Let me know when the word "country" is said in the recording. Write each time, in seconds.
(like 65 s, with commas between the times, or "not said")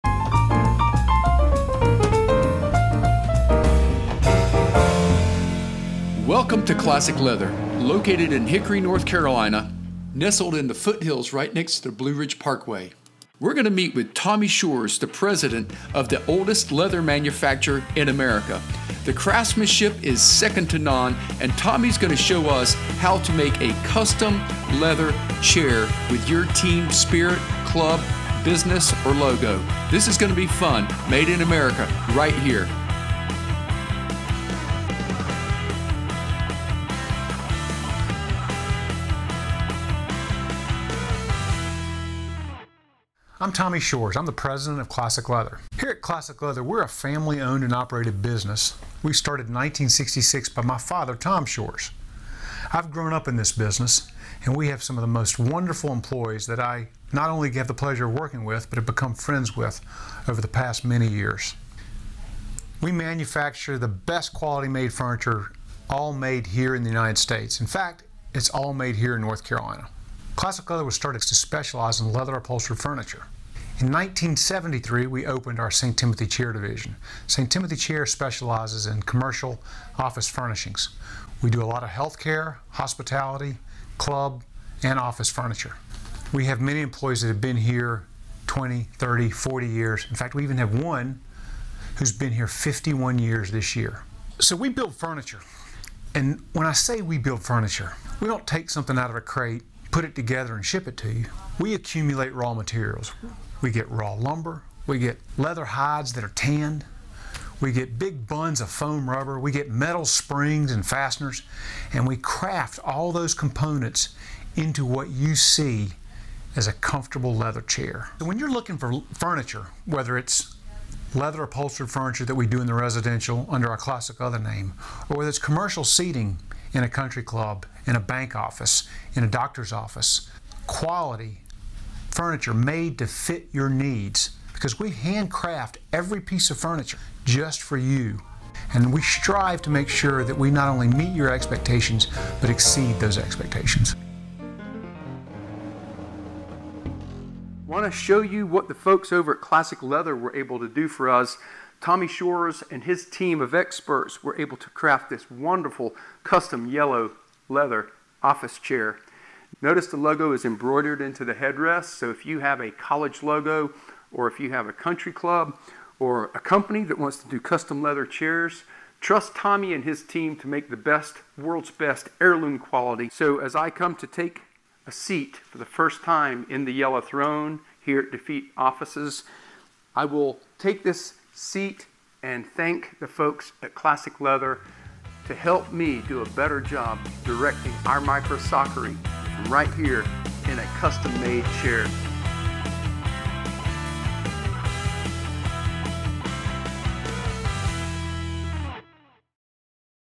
126 s, 164 s.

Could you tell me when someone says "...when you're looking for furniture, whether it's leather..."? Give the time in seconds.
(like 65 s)
118 s.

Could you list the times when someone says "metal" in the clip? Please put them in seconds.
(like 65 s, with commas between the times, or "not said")
109 s.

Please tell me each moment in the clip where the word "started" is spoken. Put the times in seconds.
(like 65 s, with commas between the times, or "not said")
49 s, 70 s.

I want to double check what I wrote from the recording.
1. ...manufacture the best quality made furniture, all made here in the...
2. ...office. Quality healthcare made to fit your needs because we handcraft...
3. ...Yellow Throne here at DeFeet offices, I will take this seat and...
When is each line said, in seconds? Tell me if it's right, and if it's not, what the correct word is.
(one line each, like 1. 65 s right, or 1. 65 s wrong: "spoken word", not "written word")
1. 62 s right
2. 129 s wrong: "furniture", not "healthcare"
3. 176 s right.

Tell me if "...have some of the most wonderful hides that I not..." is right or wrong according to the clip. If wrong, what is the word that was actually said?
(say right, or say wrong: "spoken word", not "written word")
wrong: "employees", not "hides".